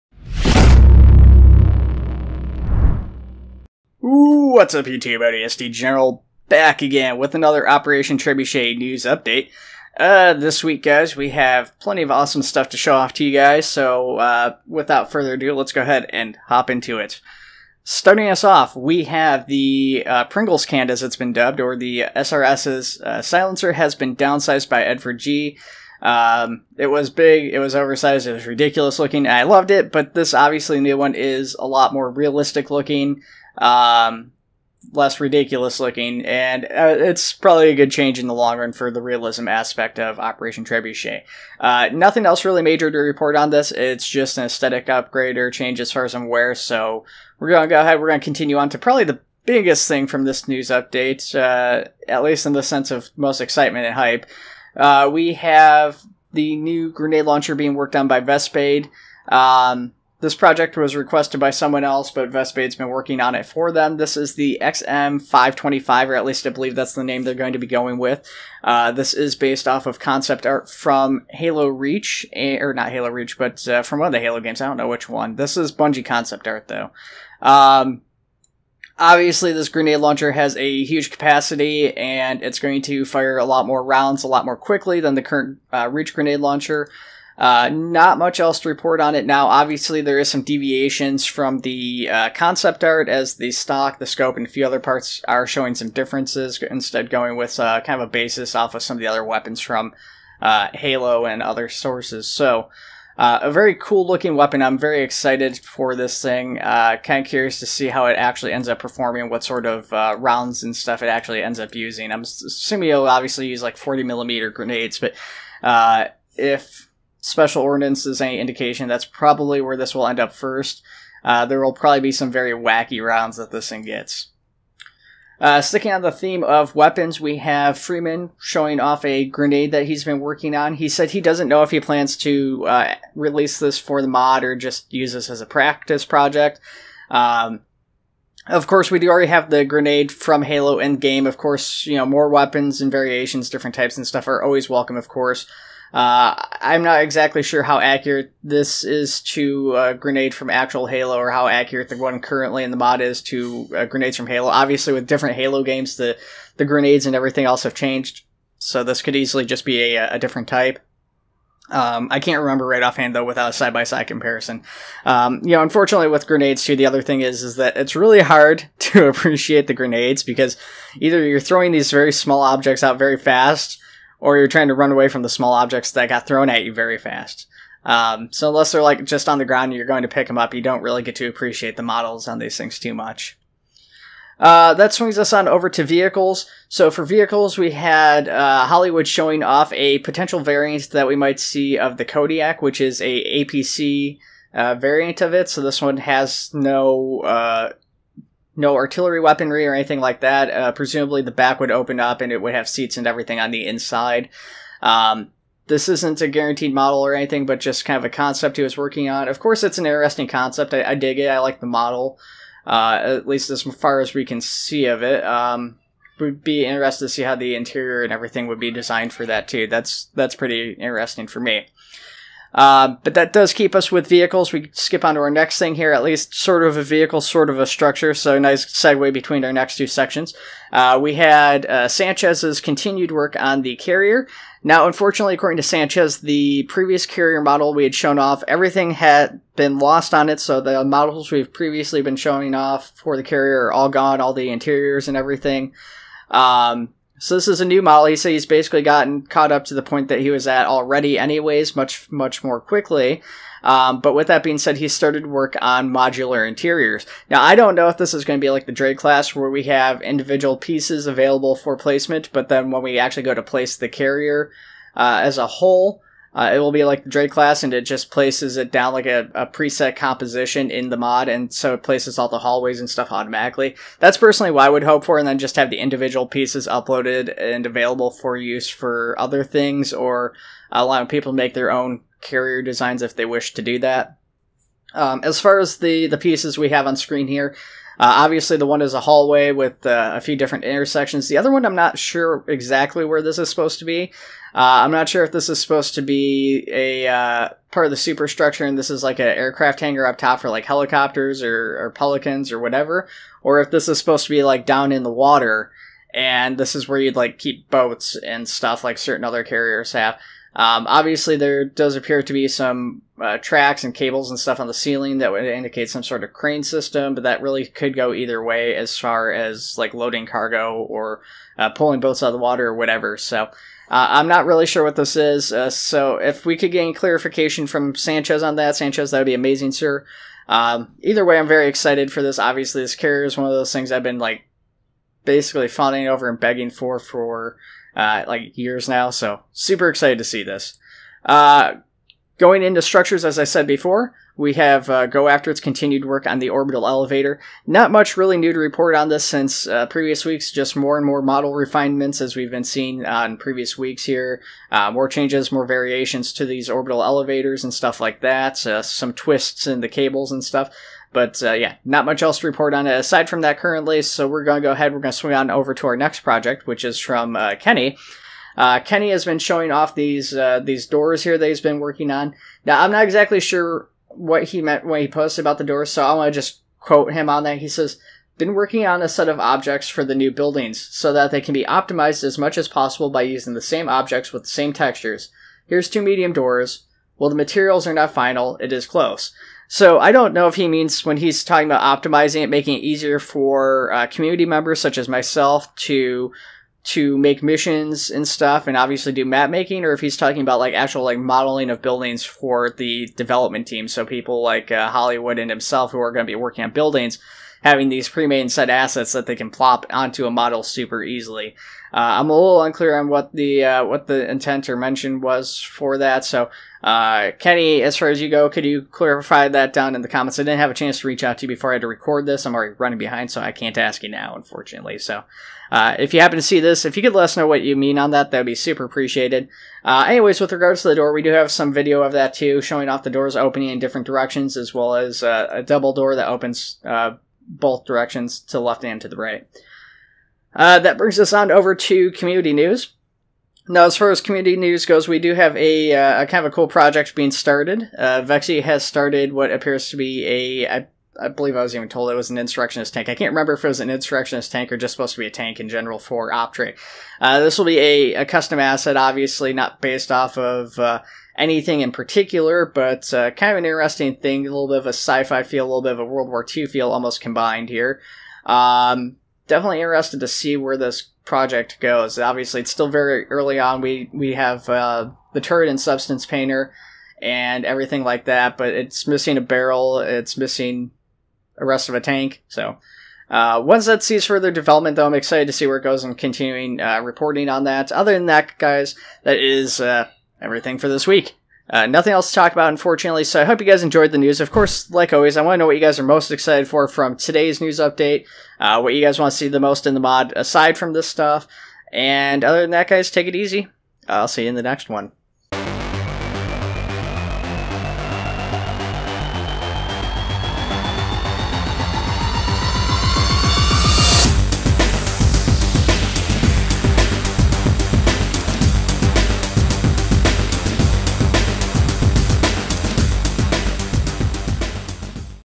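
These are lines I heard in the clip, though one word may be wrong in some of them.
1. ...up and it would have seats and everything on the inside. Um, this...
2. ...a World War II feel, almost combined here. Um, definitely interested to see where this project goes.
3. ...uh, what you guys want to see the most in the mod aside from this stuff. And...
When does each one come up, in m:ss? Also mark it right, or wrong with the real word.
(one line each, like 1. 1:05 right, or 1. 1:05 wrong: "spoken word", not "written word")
1. 3:21 right
2. 7:45 right
3. 8:18 right.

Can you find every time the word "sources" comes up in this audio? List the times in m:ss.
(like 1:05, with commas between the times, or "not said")
1:41.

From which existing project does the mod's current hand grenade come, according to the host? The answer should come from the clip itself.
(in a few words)
Halo Endgame.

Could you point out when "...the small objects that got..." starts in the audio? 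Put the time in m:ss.
2:55.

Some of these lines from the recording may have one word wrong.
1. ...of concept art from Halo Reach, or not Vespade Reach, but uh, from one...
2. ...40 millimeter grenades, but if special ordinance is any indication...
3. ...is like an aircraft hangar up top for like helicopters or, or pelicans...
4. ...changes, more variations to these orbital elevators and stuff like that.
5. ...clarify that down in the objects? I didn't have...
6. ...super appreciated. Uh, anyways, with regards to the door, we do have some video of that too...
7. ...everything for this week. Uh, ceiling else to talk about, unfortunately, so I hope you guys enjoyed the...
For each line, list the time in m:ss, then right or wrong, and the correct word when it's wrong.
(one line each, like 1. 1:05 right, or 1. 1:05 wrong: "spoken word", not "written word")
1. 1:09 wrong: "Halo", not "Vespade"
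2. 1:53 right
3. 4:58 right
4. 5:55 right
5. 6:58 wrong: "comments", not "objects"
6. 7:08 right
7. 8:10 wrong: "nothing", not "ceiling".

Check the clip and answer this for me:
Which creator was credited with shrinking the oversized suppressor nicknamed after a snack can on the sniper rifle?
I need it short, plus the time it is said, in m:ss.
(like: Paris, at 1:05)
Edward G, at 0:24.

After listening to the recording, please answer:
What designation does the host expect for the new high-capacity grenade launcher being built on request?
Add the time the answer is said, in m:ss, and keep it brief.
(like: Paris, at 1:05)
XM525, at 1:04.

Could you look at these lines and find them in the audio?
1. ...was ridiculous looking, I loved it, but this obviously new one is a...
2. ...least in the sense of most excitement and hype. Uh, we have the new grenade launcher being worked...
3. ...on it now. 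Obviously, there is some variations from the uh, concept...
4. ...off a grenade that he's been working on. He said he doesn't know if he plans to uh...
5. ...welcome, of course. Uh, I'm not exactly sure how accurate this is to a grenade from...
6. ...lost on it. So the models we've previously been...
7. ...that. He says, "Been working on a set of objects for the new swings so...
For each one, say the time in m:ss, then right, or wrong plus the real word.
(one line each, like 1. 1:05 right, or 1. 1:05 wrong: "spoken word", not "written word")
1. 0:28 right
2. 0:52 right
3. 1:29 wrong: "deviations", not "variations"
4. 2:08 right
5. 2:24 right
6. 3:59 right
7. 6:17 wrong: "buildings", not "swings".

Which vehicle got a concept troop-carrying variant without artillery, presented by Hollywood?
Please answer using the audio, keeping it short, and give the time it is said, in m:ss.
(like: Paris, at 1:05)
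Kodiak, at 3:12.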